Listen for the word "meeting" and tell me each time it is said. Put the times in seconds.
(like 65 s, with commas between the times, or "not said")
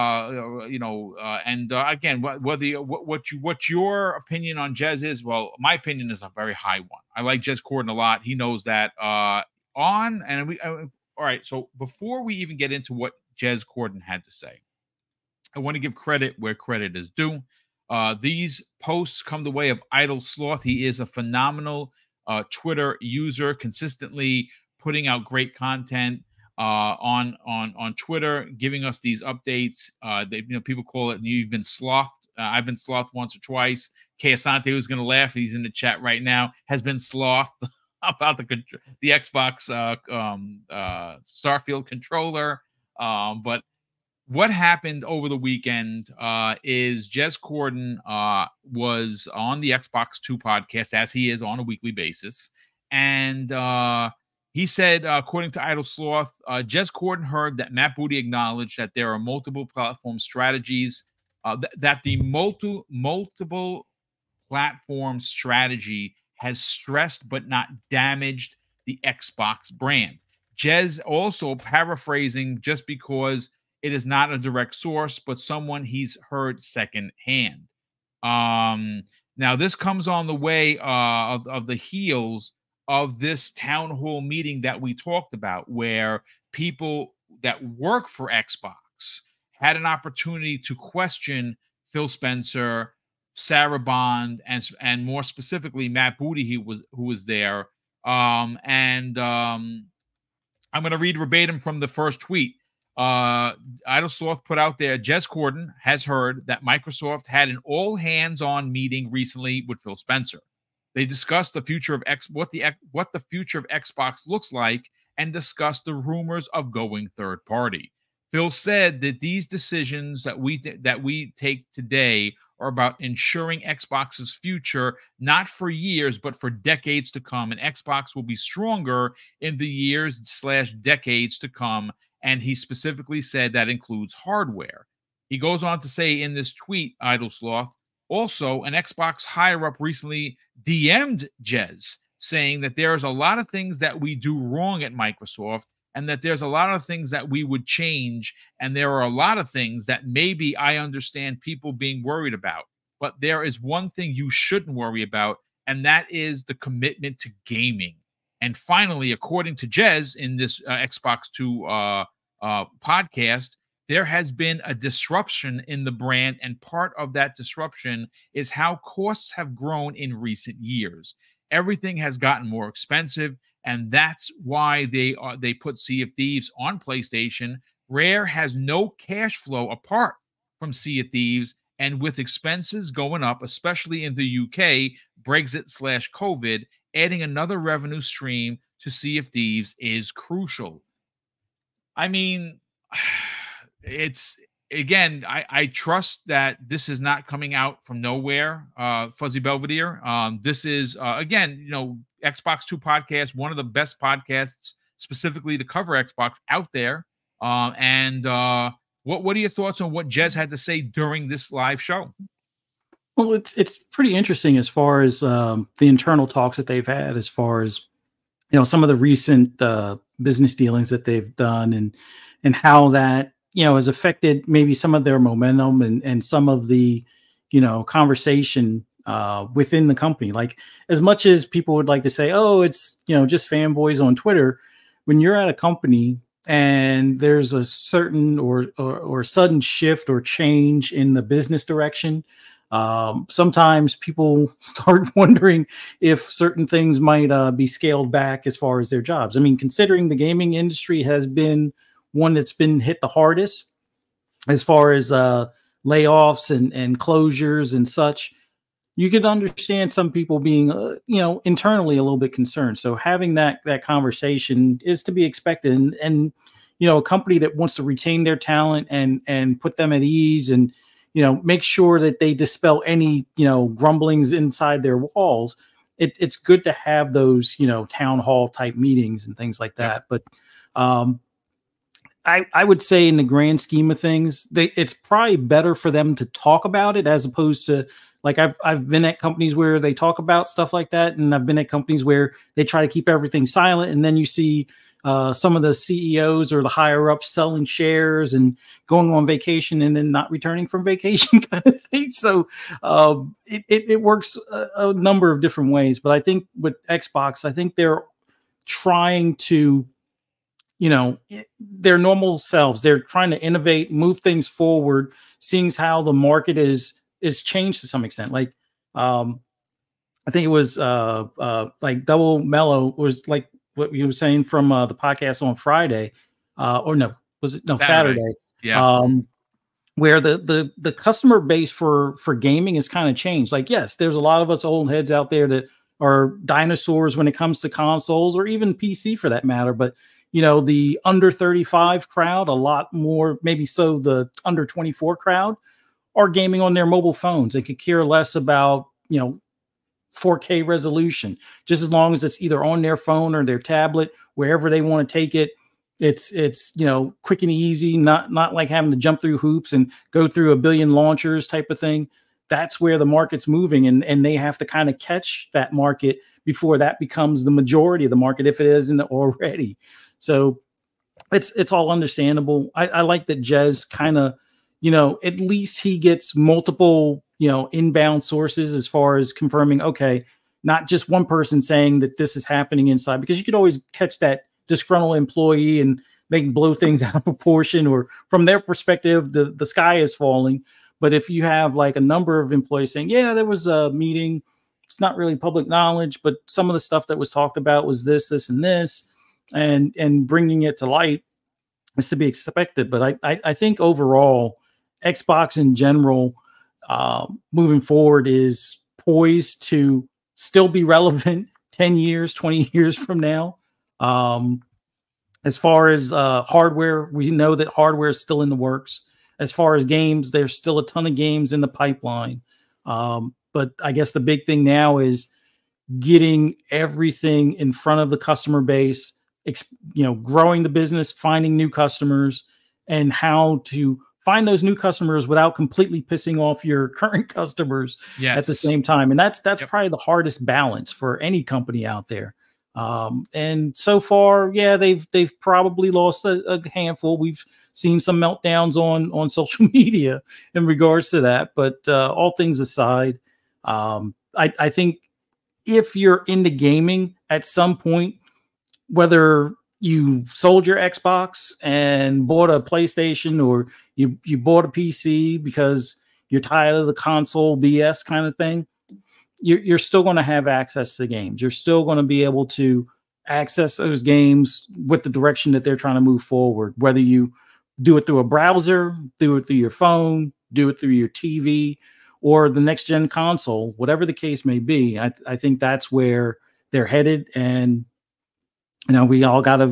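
84 s, 108 s, 278 s, 393 s.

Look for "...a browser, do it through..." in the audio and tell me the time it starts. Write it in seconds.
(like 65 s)
478 s.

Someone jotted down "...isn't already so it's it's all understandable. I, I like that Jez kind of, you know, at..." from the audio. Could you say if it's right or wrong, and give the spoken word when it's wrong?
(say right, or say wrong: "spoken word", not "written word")
right.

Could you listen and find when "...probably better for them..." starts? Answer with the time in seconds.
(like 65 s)
284 s.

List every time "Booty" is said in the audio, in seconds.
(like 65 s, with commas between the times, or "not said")
57 s, 96 s.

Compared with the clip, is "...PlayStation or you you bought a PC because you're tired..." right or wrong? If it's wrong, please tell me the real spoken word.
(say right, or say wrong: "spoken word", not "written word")
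right.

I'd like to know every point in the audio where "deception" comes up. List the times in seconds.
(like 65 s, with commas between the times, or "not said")
not said.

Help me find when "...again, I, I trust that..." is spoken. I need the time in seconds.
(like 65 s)
194 s.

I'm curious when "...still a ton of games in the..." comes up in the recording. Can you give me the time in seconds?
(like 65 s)
420 s.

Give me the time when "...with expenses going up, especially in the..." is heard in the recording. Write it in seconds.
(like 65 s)
181 s.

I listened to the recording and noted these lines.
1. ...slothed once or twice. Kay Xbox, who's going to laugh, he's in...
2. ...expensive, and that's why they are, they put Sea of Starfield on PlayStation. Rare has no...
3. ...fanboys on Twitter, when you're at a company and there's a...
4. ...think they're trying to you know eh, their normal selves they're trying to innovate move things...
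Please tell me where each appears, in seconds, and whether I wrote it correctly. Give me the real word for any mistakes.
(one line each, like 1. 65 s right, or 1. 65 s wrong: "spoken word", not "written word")
1. 32 s wrong: "Asante", not "Xbox"
2. 172 s wrong: "Thieves", not "Starfield"
3. 233 s right
4. 307 s right.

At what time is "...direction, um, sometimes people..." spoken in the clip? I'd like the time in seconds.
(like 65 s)
241 s.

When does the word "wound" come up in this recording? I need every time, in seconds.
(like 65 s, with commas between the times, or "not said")
not said.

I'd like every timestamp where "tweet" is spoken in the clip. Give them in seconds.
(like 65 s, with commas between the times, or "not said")
102 s, 136 s.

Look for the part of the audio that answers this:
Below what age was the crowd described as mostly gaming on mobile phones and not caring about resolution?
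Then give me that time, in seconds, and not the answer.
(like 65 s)
344 s.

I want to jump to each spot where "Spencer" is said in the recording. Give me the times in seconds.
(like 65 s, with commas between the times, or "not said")
92 s, 109 s.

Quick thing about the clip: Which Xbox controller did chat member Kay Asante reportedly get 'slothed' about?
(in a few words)
Starfield controller.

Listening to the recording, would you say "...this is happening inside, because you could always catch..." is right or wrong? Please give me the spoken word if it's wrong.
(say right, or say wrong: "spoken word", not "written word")
right.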